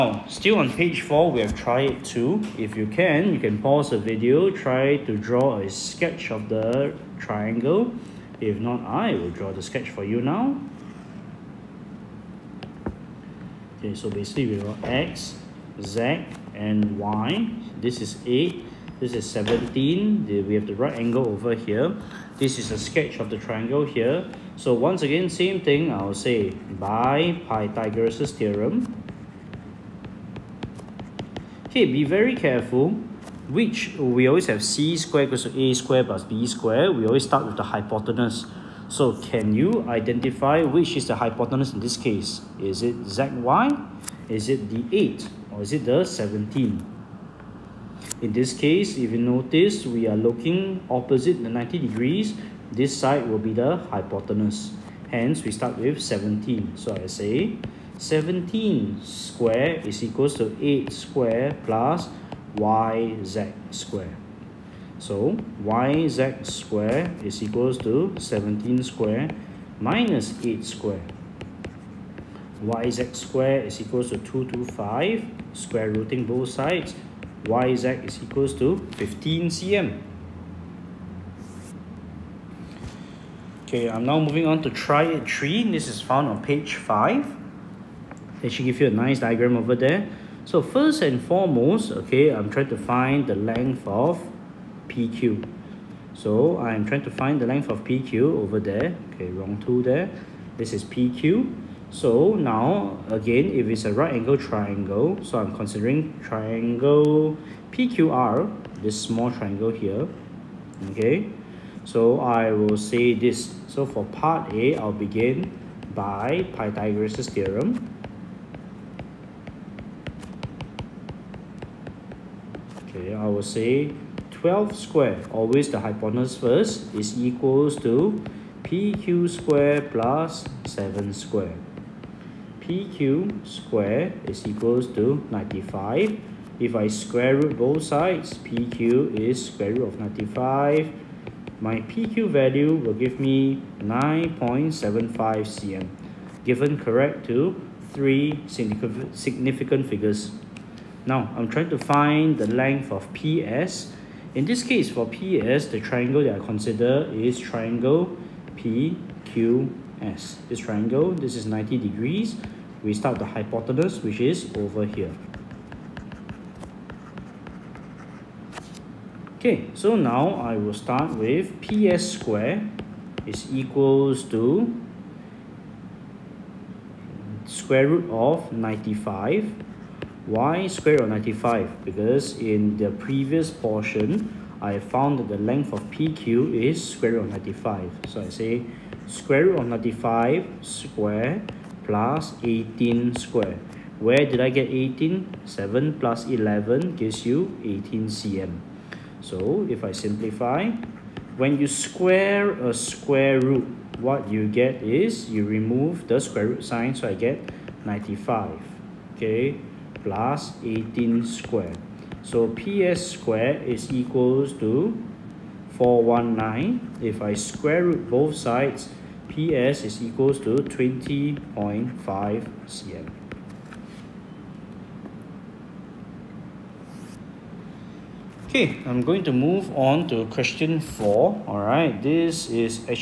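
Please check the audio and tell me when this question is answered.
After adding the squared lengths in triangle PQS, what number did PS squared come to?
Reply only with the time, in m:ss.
3:35.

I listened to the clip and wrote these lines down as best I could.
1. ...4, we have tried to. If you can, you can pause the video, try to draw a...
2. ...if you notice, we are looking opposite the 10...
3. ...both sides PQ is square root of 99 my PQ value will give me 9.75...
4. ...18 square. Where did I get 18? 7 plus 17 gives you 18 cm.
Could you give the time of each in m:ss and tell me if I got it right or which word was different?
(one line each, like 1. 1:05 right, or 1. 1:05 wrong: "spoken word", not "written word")
1. 0:01 right
2. 0:48 wrong: "90", not "10"
3. 2:17 wrong: "95", not "99"
4. 3:12 wrong: "11", not "17".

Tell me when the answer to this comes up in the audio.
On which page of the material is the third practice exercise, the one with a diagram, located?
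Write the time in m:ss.
1:26.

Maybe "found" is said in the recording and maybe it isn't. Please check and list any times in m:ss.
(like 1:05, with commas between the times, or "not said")
1:26, 3:04.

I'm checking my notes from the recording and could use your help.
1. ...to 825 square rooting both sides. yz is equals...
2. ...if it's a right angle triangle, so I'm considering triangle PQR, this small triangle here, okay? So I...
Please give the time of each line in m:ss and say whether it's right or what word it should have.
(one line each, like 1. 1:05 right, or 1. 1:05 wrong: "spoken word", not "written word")
1. 1:14 wrong: "225", not "825"
2. 1:43 right.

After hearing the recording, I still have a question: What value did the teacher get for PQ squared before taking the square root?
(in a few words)
95.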